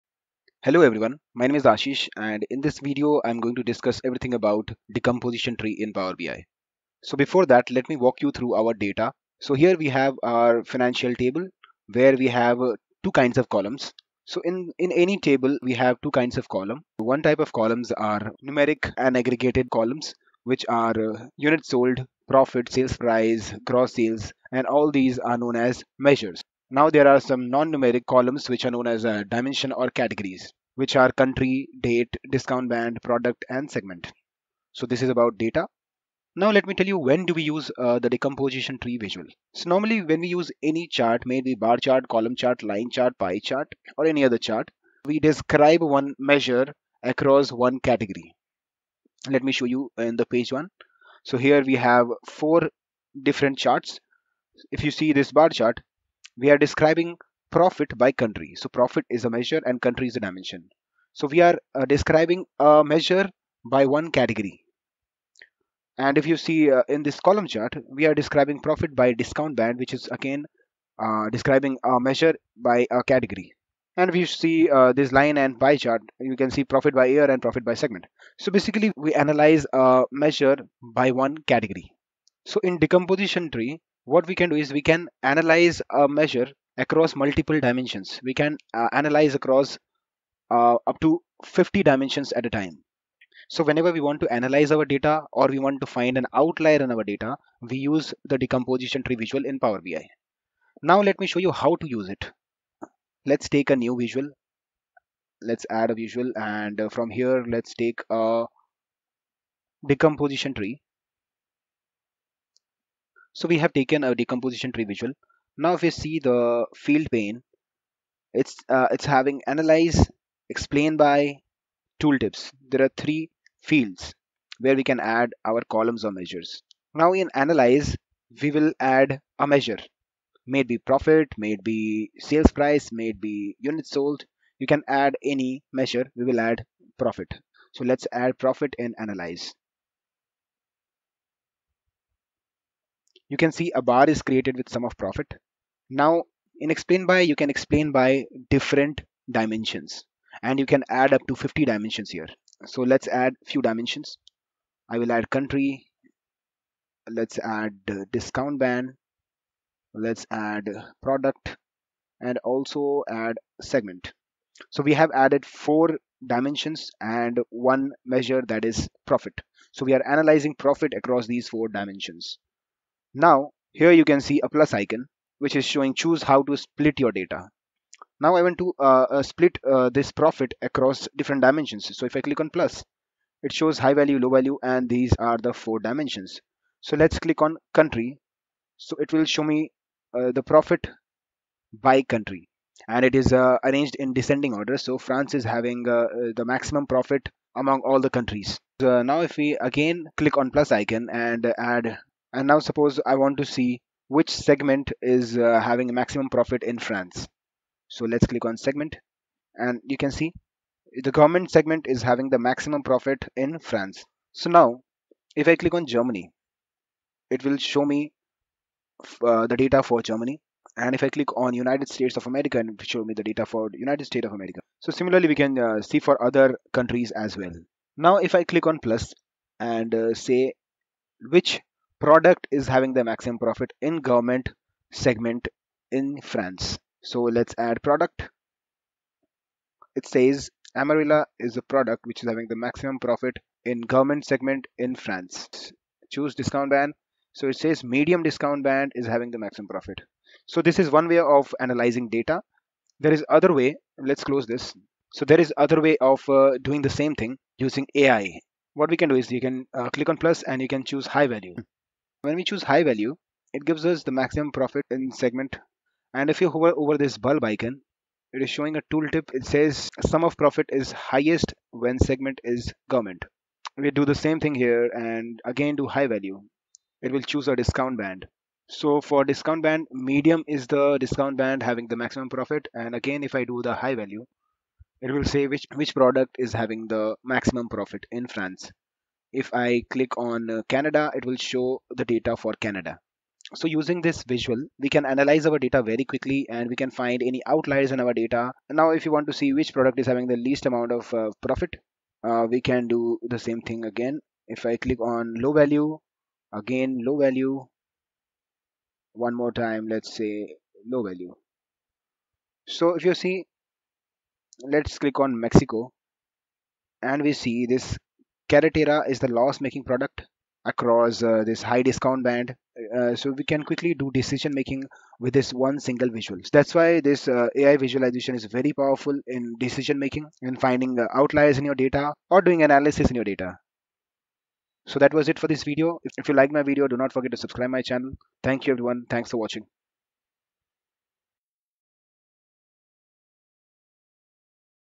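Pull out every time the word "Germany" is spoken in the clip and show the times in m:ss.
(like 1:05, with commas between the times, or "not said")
3:35, 3:40.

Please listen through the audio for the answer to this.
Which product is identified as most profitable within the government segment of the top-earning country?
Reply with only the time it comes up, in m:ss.
4:00.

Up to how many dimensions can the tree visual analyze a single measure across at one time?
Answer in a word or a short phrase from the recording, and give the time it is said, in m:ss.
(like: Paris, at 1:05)
50, at 1:31.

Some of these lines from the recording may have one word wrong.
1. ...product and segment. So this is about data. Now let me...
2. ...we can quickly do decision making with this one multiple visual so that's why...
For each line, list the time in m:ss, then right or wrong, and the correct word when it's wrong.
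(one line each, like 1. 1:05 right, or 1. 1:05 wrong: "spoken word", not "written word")
1. 0:33 right
2. 5:23 wrong: "single", not "multiple".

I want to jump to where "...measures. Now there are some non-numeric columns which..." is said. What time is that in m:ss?
0:25.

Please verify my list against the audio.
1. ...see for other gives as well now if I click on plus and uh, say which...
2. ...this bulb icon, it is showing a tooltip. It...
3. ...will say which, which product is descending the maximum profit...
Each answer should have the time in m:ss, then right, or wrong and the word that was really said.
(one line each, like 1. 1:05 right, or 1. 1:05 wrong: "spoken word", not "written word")
1. 3:45 wrong: "countries", not "gives"
2. 4:26 right
3. 4:45 wrong: "having", not "descending".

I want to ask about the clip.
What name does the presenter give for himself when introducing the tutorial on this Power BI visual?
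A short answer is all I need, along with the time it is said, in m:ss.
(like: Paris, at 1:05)
Ashish, at 0:01.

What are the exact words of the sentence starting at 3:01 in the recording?
So if I click on plus, it shows high value, low value, and these are the four dimensions.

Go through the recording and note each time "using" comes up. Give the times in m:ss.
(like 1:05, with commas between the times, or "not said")
4:17, 4:53.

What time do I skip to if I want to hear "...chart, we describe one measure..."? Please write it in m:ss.
0:44.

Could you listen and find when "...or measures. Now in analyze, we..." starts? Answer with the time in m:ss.
2:06.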